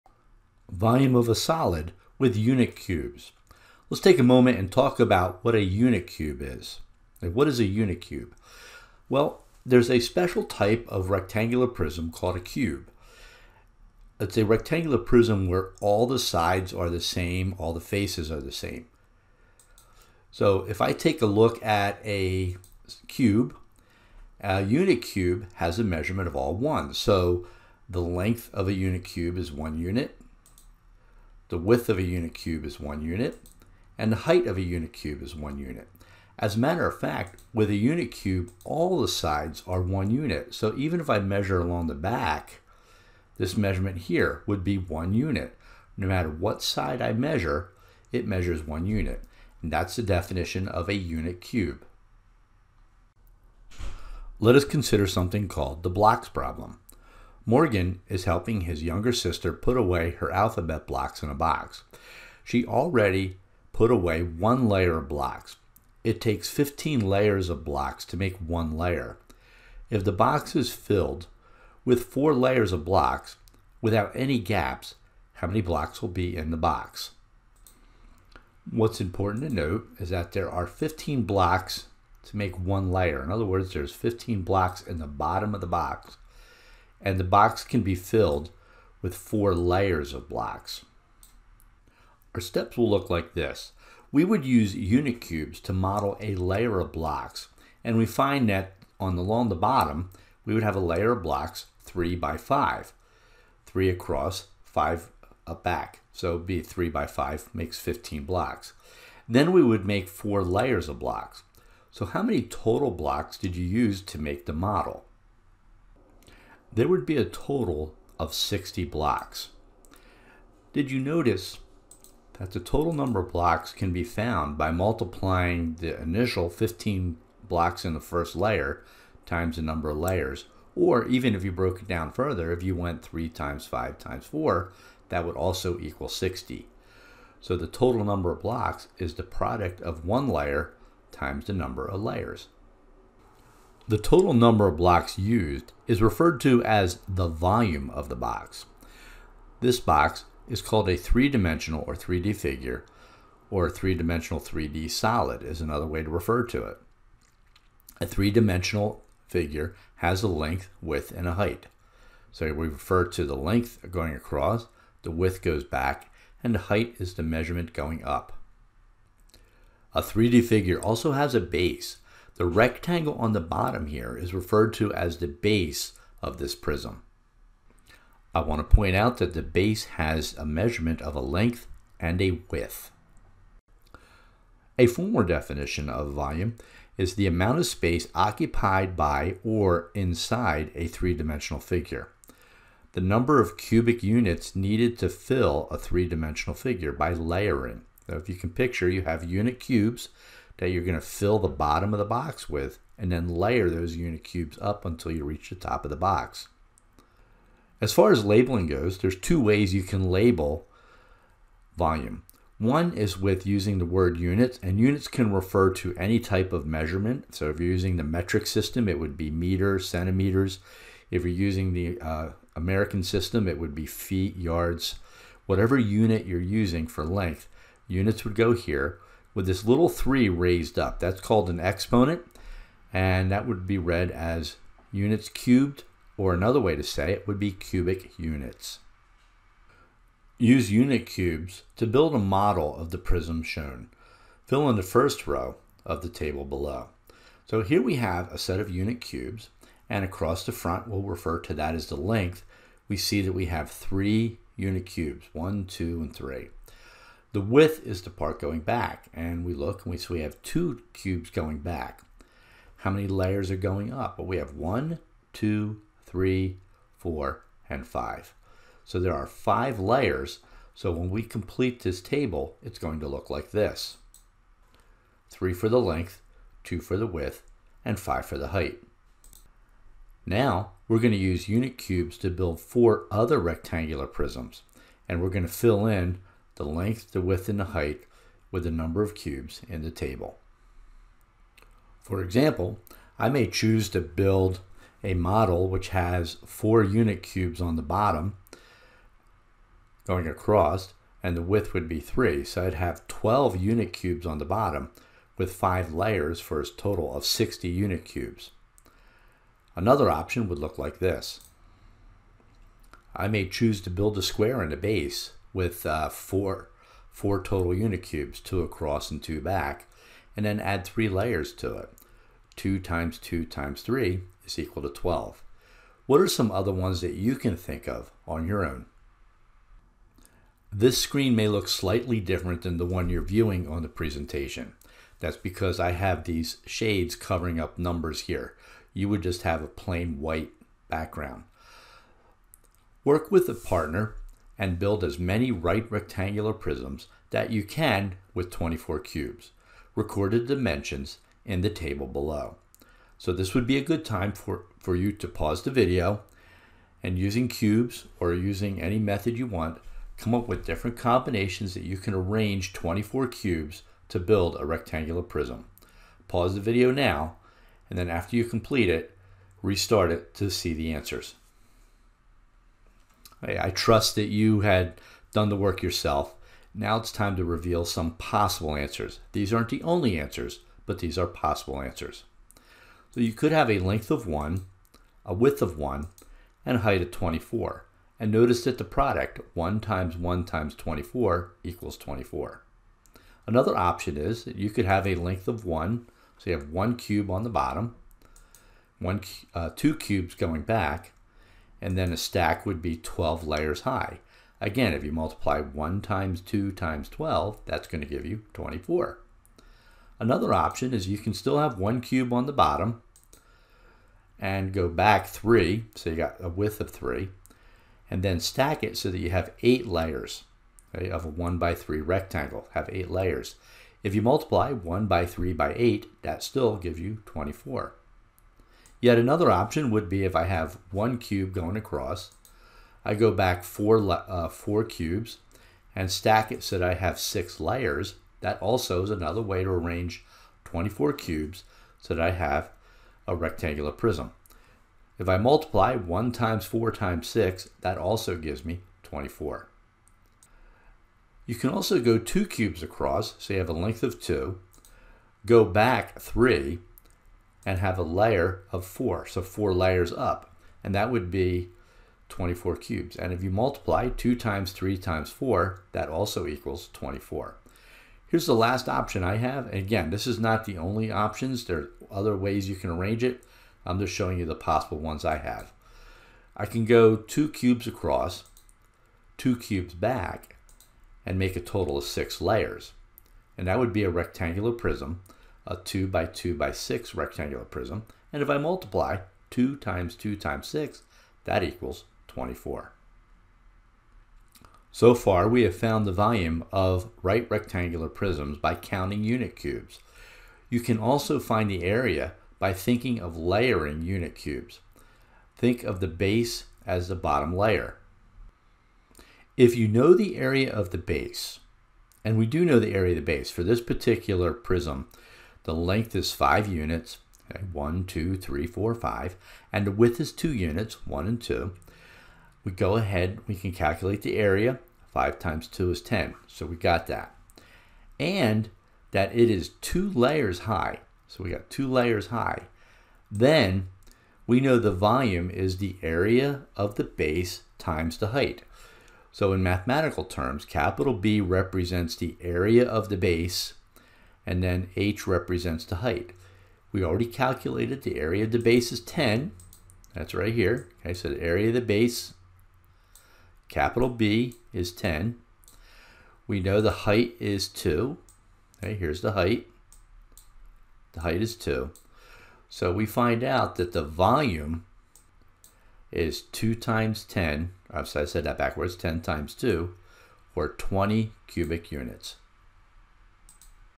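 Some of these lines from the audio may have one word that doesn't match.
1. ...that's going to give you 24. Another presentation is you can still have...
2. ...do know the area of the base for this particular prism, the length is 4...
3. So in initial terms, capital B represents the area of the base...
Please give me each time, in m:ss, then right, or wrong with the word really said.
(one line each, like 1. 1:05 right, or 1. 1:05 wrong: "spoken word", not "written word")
1. 6:47 wrong: "option", not "presentation"
2. 8:32 wrong: "5", not "4"
3. 8:59 wrong: "mathematical", not "initial".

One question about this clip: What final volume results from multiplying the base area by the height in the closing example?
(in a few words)
20 cubic units.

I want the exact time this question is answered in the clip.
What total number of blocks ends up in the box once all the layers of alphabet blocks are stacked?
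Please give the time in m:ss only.
1:58.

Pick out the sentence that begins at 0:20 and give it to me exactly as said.
So if I take a look at a cube, a unit cube has a measurement of all ones.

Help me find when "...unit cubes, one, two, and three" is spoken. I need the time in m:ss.
4:14.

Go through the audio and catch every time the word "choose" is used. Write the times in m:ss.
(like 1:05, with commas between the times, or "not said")
4:53, 5:13.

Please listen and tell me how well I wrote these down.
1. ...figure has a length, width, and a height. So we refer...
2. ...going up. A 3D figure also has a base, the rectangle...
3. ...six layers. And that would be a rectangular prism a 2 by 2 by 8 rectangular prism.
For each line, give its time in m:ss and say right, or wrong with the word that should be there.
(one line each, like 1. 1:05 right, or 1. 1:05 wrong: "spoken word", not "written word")
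1. 2:39 right
2. 2:47 right
3. 8:02 wrong: "6", not "8".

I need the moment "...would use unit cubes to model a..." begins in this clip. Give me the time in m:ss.
1:34.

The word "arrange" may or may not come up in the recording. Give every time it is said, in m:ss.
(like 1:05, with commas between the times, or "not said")
6:02, 7:19, 7:52.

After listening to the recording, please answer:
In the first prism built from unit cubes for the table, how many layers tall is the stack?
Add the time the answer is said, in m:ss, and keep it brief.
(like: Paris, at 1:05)
5, at 4:29.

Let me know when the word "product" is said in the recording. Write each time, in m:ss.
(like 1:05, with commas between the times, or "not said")
2:19, 6:28.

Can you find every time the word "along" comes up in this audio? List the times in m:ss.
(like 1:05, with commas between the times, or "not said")
0:41, 1:39.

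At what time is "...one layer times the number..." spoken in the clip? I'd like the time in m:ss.
2:20.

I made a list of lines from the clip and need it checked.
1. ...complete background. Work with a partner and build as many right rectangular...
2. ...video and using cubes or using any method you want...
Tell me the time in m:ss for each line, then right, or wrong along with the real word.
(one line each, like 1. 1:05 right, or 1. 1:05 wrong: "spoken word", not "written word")
1. 5:40 wrong: "white", not "complete"
2. 5:55 right.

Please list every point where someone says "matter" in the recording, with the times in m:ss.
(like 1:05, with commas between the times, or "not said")
0:36, 0:46.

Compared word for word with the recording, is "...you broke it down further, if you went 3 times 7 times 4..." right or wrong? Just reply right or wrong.
wrong.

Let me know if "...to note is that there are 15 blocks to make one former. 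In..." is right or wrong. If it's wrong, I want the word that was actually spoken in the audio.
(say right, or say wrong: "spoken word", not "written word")
wrong: "layer", not "former".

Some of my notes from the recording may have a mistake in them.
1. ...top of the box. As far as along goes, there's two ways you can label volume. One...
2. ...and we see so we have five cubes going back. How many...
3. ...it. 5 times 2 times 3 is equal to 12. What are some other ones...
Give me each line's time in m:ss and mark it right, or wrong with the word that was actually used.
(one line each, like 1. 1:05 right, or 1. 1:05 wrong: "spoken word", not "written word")
1. 3:25 wrong: "labeling", not "along"
2. 4:19 wrong: "two", not "five"
3. 5:21 wrong: "2", not "5".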